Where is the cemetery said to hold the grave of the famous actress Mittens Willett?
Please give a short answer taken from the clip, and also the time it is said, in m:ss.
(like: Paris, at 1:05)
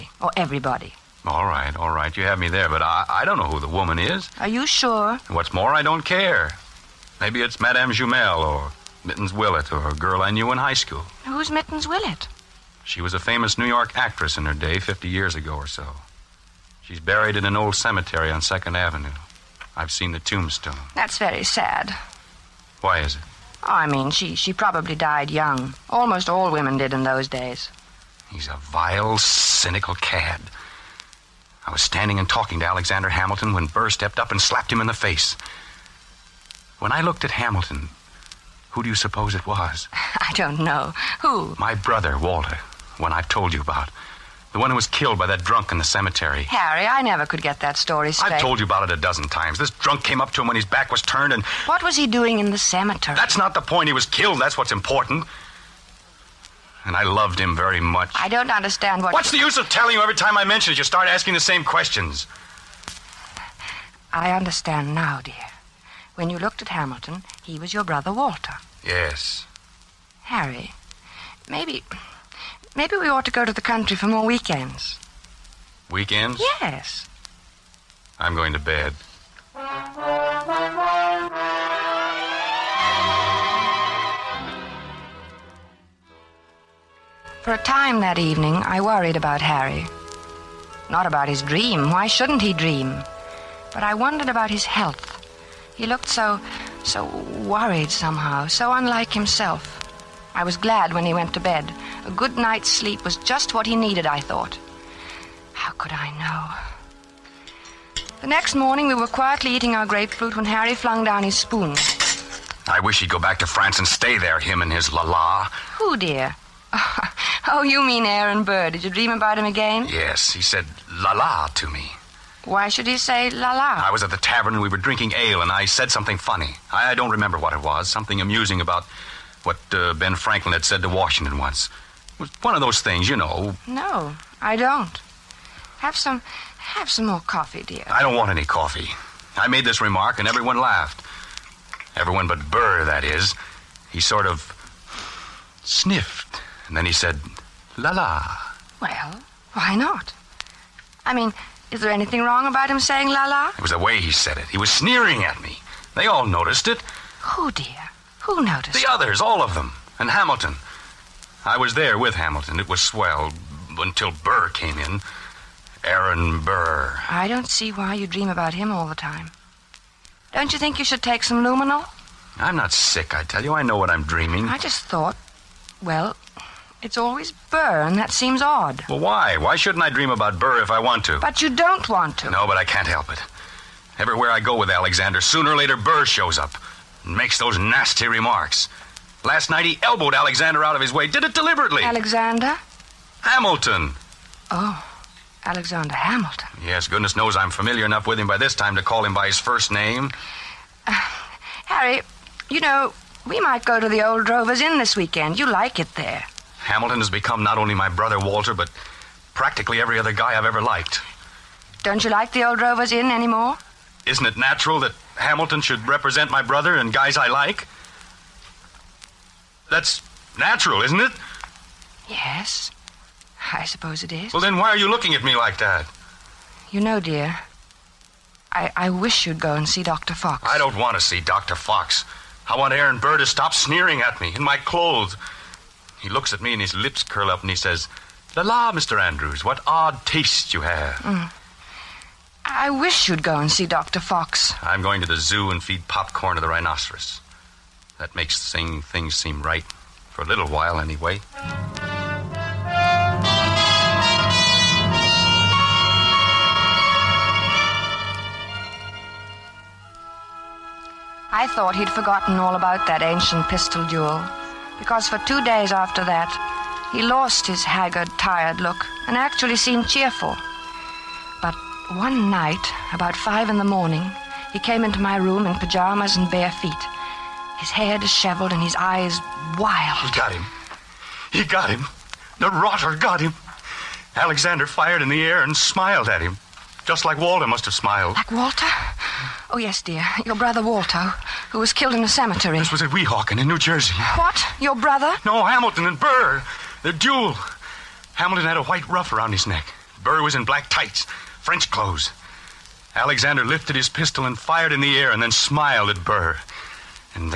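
2nd Avenue, at 0:18.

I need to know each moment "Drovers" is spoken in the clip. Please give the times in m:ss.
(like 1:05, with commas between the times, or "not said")
3:24, 3:32.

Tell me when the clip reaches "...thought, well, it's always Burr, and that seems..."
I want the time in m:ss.
2:54.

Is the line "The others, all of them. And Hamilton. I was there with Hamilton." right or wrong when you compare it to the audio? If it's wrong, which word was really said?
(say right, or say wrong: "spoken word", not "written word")
right.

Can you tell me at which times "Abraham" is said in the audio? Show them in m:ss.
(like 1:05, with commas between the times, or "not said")
not said.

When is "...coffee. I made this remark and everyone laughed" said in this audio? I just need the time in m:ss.
2:18.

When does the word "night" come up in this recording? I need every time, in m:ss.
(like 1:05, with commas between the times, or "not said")
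1:42, 3:09, 4:32.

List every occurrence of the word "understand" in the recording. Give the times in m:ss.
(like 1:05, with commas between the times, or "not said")
0:58, 1:04.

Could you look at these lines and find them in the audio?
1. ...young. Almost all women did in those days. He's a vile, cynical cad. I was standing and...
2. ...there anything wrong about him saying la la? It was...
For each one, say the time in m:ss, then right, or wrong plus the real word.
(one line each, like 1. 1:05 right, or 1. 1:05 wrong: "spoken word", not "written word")
1. 0:25 right
2. 2:31 right.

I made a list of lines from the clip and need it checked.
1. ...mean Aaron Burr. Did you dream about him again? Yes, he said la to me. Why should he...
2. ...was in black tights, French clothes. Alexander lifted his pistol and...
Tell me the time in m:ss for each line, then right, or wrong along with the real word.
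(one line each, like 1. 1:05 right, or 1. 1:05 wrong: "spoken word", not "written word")
1. 1:57 right
2. 5:00 right.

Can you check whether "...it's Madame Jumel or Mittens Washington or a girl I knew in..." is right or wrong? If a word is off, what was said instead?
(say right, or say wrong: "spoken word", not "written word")
wrong: "Willett", not "Washington".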